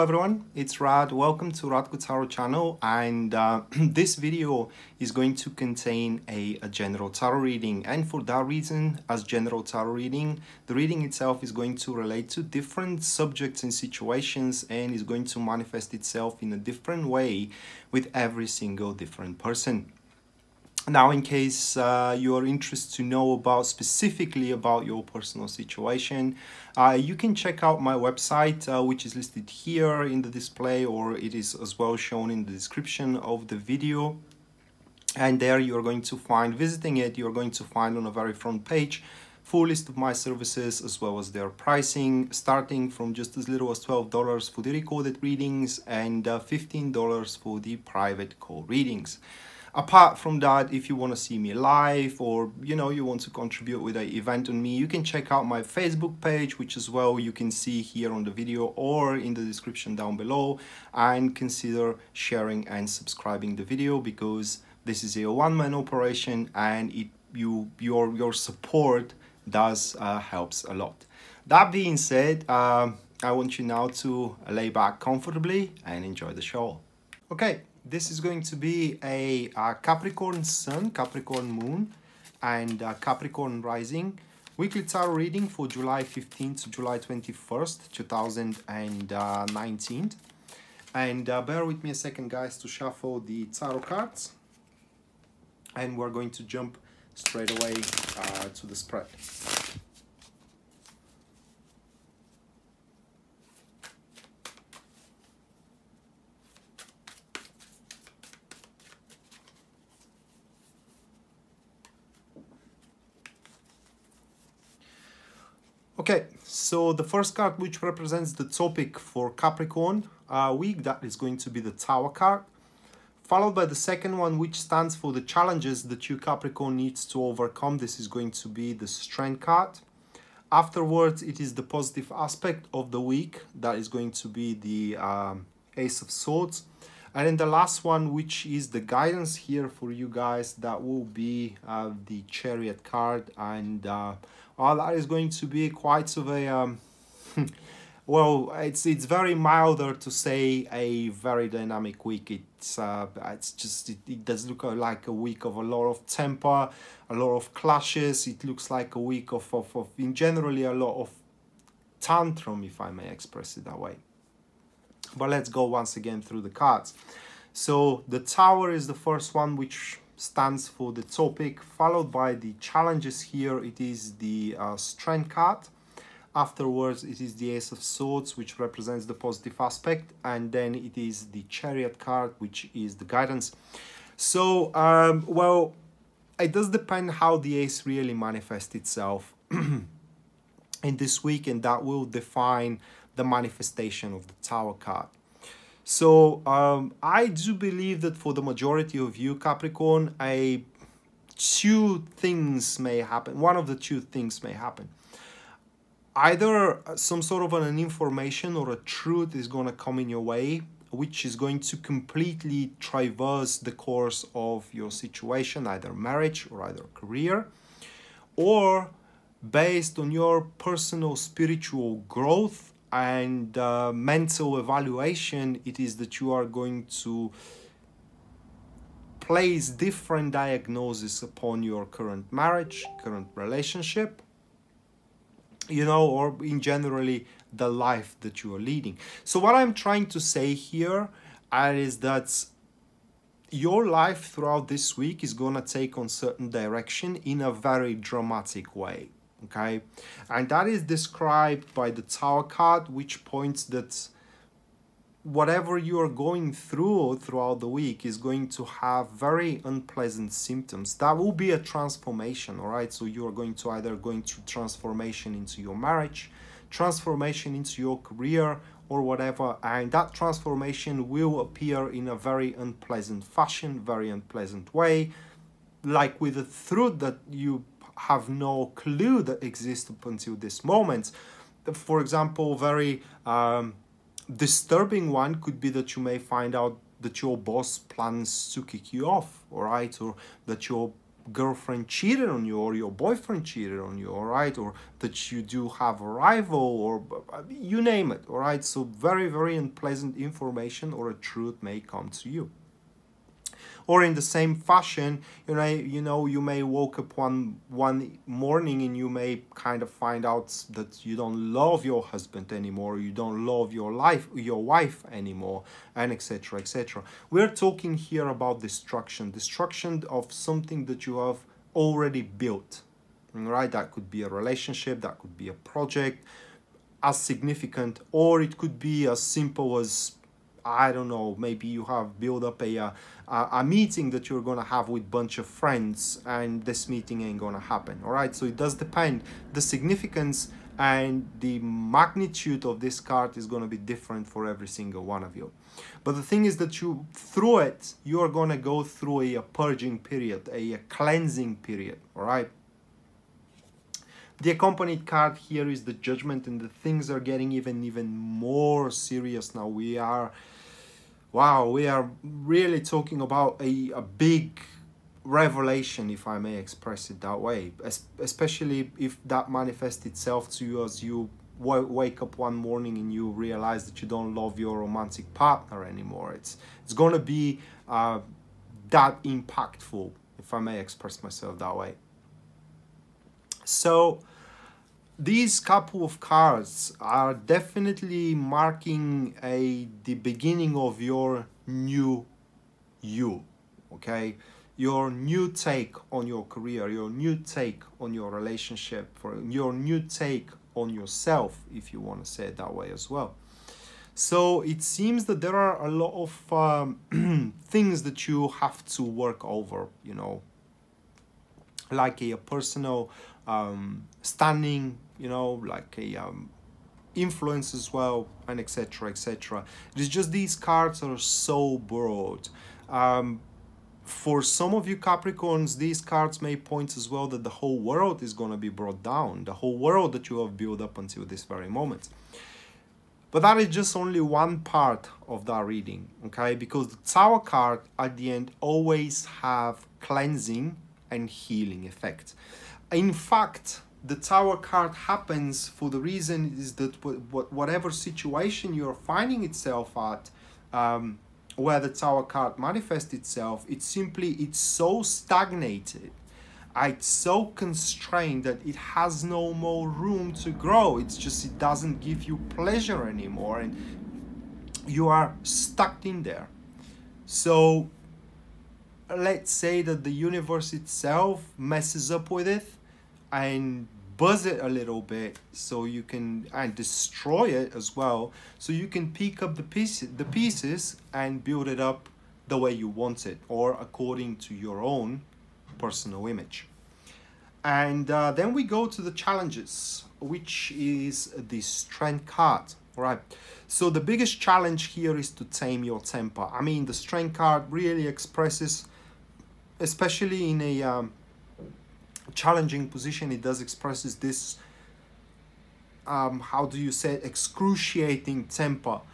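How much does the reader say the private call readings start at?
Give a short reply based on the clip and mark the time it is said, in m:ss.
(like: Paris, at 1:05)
$15, at 0:46.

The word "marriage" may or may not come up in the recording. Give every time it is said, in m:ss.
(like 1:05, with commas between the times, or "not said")
3:35, 3:52, 4:25.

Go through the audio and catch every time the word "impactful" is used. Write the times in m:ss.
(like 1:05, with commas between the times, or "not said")
6:19.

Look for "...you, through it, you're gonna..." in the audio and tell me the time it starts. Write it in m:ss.
5:46.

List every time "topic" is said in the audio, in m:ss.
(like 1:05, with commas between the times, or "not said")
1:58, 2:51.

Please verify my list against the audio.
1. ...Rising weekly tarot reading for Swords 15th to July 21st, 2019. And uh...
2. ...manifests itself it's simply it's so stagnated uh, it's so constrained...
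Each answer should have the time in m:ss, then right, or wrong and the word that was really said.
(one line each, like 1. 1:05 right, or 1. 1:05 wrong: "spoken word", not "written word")
1. 1:23 wrong: "July", not "Swords"
2. 7:32 right.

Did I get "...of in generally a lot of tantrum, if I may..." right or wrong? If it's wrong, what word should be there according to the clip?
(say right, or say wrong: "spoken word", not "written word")
right.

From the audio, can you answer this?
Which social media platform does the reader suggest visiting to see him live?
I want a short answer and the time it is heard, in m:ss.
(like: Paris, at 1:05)
Facebook, at 0:55.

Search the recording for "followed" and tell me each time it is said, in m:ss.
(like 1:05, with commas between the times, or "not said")
2:03, 2:51.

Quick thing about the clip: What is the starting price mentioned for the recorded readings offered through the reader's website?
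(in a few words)
$12.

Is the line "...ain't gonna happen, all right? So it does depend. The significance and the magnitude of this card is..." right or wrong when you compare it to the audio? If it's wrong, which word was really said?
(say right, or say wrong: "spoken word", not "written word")
right.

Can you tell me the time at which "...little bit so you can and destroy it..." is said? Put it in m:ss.
7:54.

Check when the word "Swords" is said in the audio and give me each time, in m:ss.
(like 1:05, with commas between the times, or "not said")
2:16, 2:57.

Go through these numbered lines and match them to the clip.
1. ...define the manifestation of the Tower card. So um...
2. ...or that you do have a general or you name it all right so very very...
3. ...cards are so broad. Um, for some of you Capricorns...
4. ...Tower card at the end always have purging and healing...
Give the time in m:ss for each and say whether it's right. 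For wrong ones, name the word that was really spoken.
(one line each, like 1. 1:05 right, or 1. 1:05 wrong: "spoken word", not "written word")
1. 3:12 right
2. 4:54 wrong: "rival", not "general"
3. 7:00 right
4. 7:17 wrong: "cleansing", not "purging".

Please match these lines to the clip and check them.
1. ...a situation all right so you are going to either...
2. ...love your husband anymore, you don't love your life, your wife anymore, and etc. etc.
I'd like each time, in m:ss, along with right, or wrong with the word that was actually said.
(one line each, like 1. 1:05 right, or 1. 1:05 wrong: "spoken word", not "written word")
1. 4:21 wrong: "transformation", not "situation"
2. 5:11 right.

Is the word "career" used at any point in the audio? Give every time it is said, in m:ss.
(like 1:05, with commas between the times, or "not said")
3:36, 4:27, 6:36.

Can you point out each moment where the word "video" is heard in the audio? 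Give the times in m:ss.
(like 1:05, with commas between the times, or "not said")
0:04, 0:33, 0:58, 1:03.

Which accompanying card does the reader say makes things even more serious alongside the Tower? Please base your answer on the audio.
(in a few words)
Judgment.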